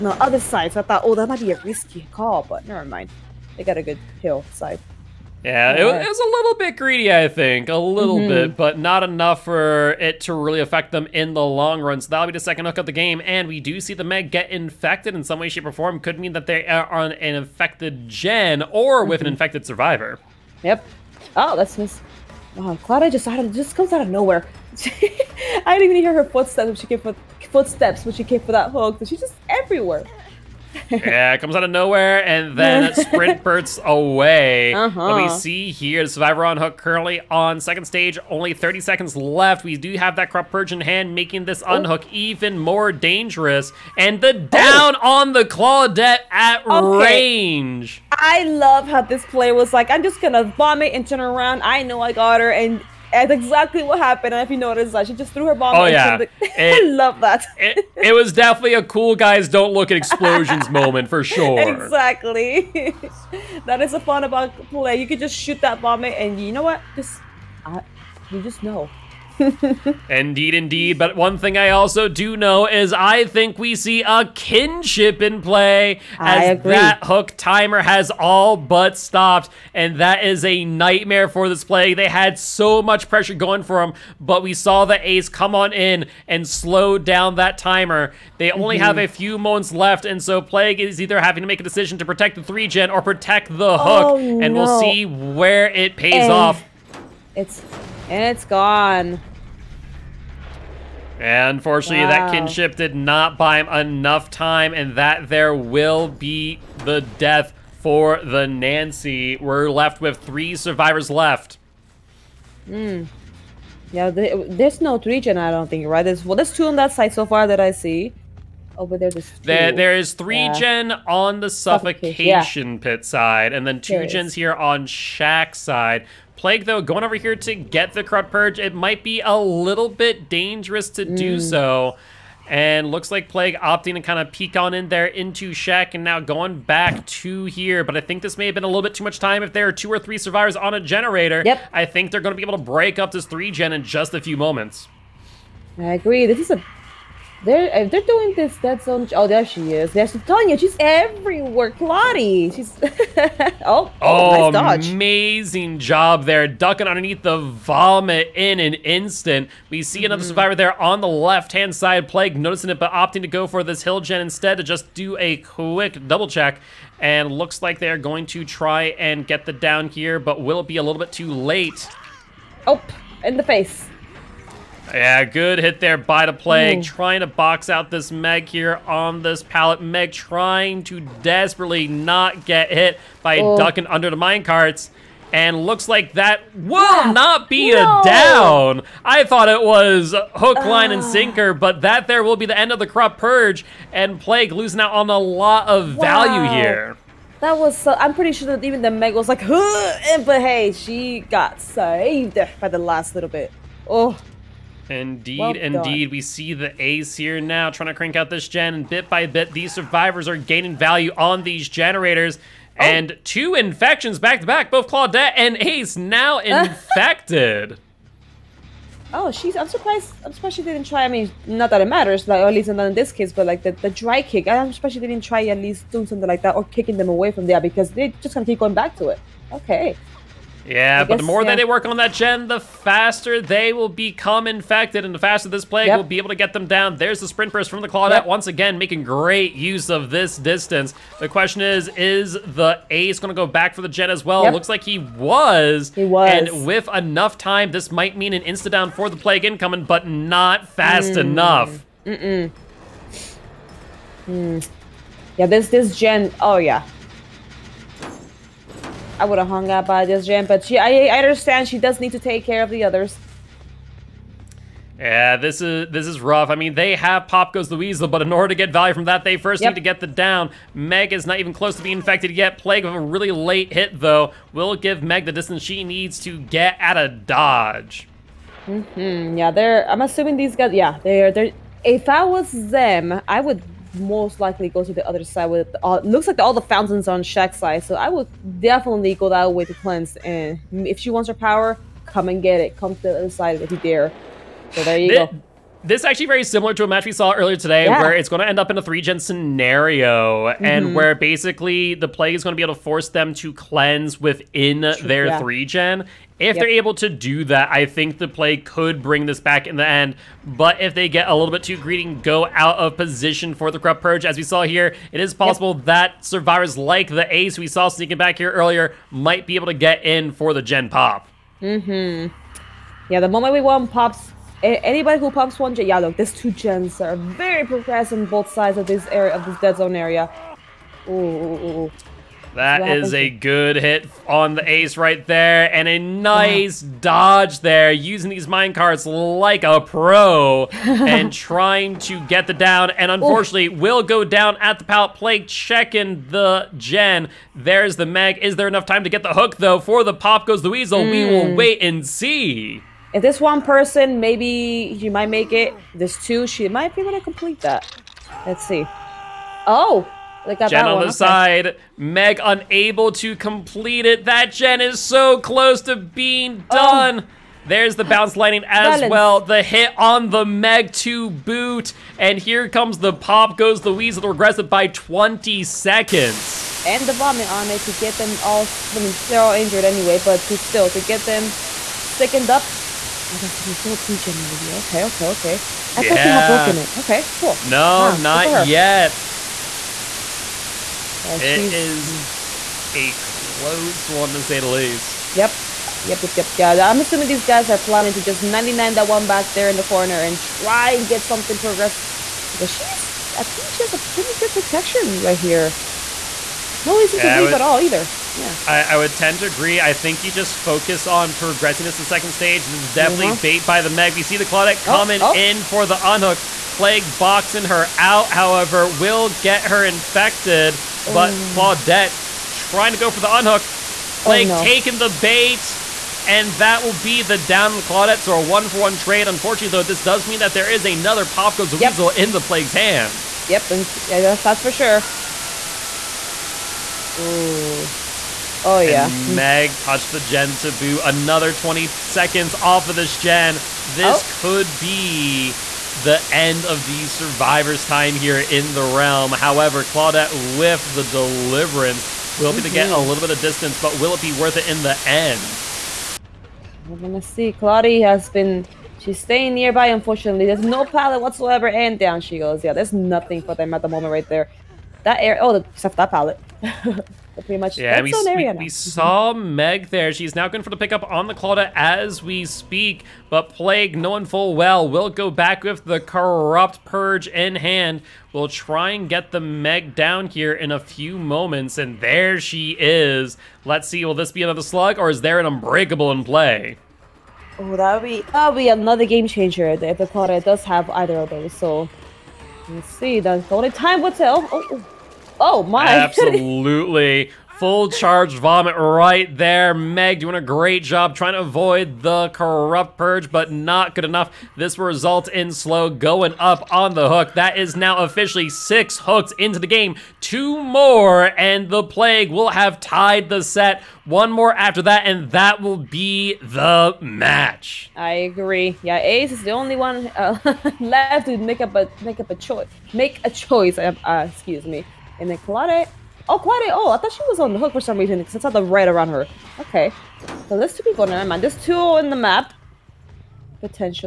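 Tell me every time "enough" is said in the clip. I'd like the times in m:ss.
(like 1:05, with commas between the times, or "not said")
0:09, 1:43, 4:06, 4:11, 5:48, 8:24.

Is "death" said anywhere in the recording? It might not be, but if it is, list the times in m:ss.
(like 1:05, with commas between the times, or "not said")
1:47.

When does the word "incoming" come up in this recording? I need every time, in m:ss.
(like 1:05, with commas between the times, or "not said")
4:09.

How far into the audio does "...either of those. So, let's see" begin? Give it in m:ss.
8:10.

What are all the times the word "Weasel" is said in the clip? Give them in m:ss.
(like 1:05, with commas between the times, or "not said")
4:27, 5:50, 6:13, 7:11.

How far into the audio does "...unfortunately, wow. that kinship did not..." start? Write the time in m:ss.
1:41.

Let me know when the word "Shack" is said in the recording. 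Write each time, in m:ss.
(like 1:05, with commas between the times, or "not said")
2:04, 2:15, 4:47.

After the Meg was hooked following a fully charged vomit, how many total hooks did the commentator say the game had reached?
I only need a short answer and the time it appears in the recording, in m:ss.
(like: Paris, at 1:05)
6, at 8:28.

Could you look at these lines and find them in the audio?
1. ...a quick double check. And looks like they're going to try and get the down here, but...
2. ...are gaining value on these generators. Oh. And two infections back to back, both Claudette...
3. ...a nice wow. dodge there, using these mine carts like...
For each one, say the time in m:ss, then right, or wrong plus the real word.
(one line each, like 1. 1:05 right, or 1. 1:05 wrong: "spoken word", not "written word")
1. 2:45 right
2. 3:30 right
3. 5:35 right.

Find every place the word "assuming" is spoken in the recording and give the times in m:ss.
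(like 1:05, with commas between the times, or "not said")
4:40, 6:36.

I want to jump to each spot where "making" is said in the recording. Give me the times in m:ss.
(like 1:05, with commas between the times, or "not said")
0:41, 3:58.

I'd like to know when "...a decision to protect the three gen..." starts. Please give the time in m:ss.
1:31.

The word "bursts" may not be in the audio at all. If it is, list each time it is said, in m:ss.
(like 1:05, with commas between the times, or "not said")
0:33, 3:57.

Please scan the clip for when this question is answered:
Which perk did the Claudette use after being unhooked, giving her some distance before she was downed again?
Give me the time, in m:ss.
7:31.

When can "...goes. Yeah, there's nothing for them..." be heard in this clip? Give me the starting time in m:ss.
7:42.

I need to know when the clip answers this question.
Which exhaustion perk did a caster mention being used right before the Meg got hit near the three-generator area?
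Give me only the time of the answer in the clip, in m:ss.
6:08.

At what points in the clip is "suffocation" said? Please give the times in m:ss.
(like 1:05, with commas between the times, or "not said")
2:01.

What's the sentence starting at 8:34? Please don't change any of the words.
One more after that, and that will be the match.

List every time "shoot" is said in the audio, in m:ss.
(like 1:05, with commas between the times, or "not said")
1:05.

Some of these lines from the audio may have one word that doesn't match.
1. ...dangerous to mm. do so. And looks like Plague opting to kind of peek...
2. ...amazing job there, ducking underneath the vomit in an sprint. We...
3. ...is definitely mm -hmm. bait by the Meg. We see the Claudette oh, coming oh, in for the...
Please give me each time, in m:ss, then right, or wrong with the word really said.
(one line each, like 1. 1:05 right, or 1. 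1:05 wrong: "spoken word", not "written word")
1. 2:10 right
2. 2:34 wrong: "instant", not "sprint"
3. 6:52 right.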